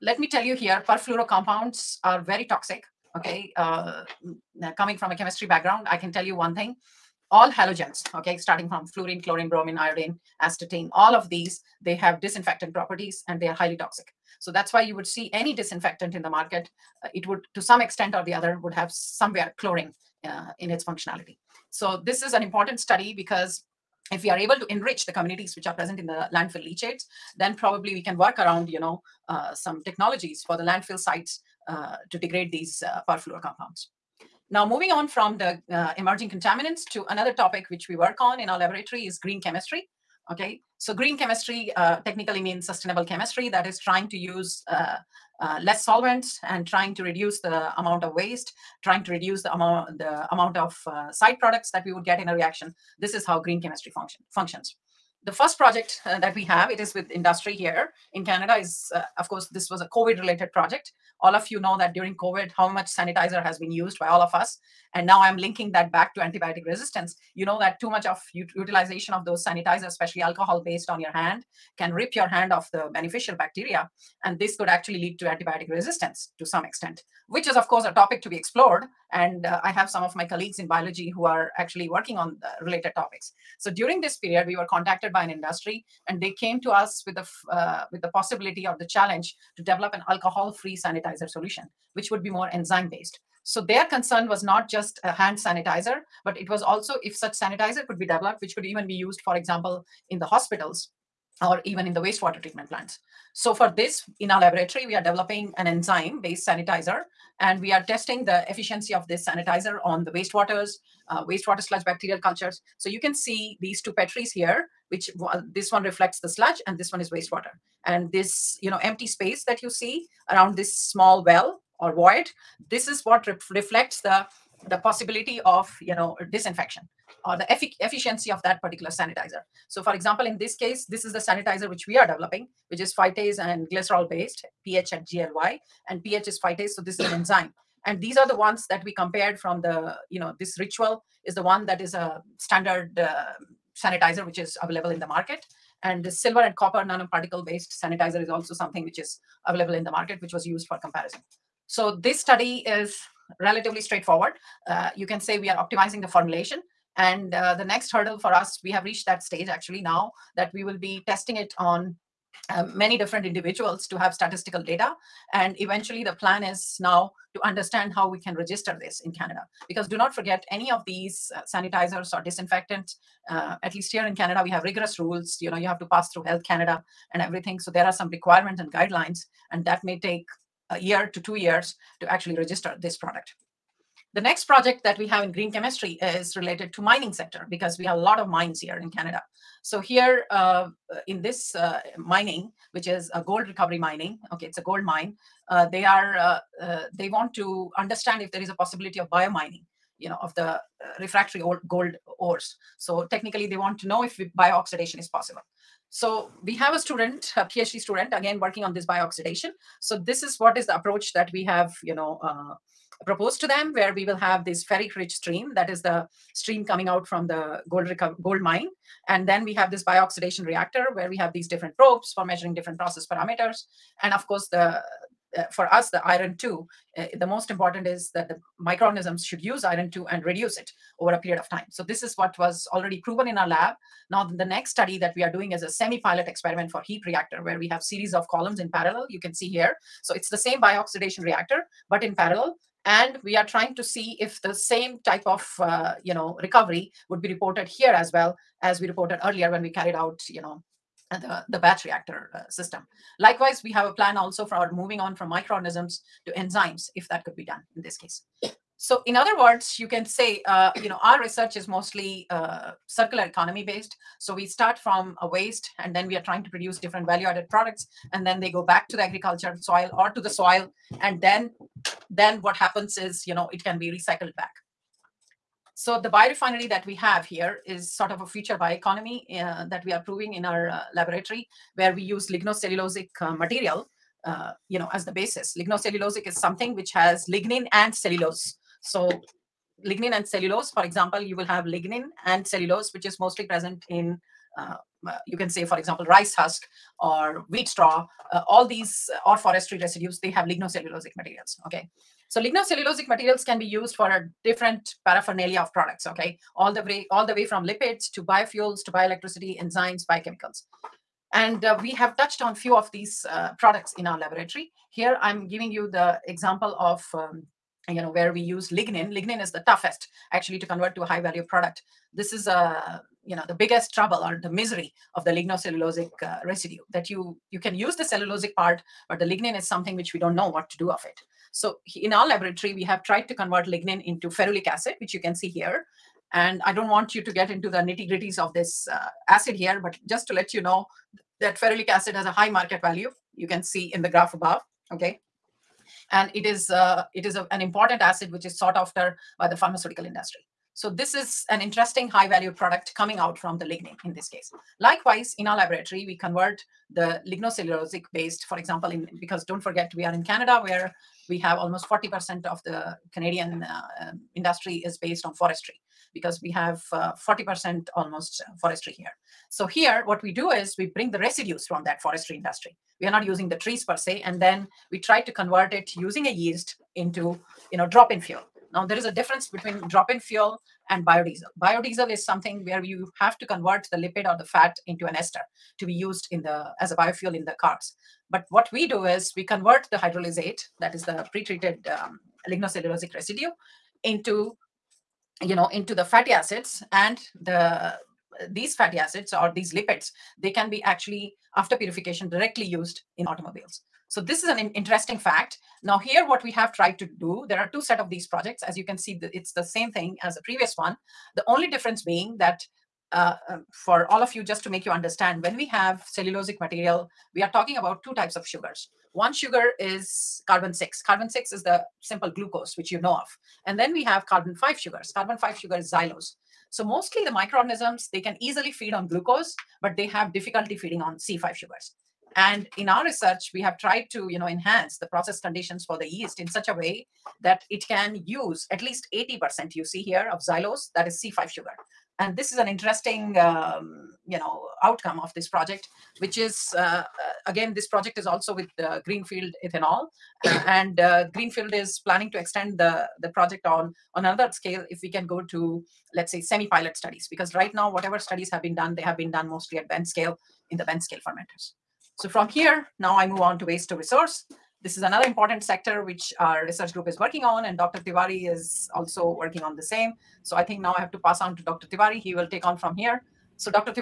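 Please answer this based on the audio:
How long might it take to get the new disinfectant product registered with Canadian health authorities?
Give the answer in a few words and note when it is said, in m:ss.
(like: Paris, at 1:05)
1 to 2 years, at 3:00.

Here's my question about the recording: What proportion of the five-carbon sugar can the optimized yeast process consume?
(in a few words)
80%.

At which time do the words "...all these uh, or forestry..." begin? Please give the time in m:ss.
4:58.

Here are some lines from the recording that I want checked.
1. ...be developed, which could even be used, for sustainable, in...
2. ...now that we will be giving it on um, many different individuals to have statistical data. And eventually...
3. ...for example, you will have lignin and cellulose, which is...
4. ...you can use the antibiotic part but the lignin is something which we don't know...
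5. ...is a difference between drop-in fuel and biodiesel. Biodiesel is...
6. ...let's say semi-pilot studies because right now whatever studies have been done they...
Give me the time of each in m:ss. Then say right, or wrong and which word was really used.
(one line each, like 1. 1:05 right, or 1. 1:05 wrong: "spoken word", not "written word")
1. 1:37 wrong: "example", not "sustainable"
2. 2:39 wrong: "testing", not "giving"
3. 4:50 right
4. 5:27 wrong: "cellulosic", not "antibiotic"
5. 6:18 right
6. 7:36 right.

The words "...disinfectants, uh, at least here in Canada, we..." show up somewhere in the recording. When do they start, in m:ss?
2:52.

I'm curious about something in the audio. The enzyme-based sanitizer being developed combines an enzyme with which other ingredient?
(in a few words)
glycerol.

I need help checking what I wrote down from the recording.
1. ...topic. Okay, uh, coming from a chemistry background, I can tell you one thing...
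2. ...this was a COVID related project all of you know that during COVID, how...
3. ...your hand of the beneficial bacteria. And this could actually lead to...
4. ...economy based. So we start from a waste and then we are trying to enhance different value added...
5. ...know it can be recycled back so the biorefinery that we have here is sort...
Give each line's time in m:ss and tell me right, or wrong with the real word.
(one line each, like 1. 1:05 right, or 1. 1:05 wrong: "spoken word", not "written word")
1. 0:02 wrong: "toxic", not "topic"
2. 0:59 right
3. 1:12 right
4. 4:23 wrong: "produce", not "enhance"
5. 4:33 right.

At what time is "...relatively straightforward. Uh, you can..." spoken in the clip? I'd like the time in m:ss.
2:33.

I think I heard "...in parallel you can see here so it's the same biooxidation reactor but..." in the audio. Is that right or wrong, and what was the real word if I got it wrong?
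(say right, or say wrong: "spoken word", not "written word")
right.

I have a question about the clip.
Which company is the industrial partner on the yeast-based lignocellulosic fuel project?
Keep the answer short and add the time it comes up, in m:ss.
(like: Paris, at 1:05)
Greenfield Ethanol, at 7:29.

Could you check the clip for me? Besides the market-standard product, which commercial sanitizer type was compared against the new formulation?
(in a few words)
silver and copper nanoparticle based.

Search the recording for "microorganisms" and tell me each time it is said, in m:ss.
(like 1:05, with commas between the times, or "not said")
3:48, 4:15, 7:07.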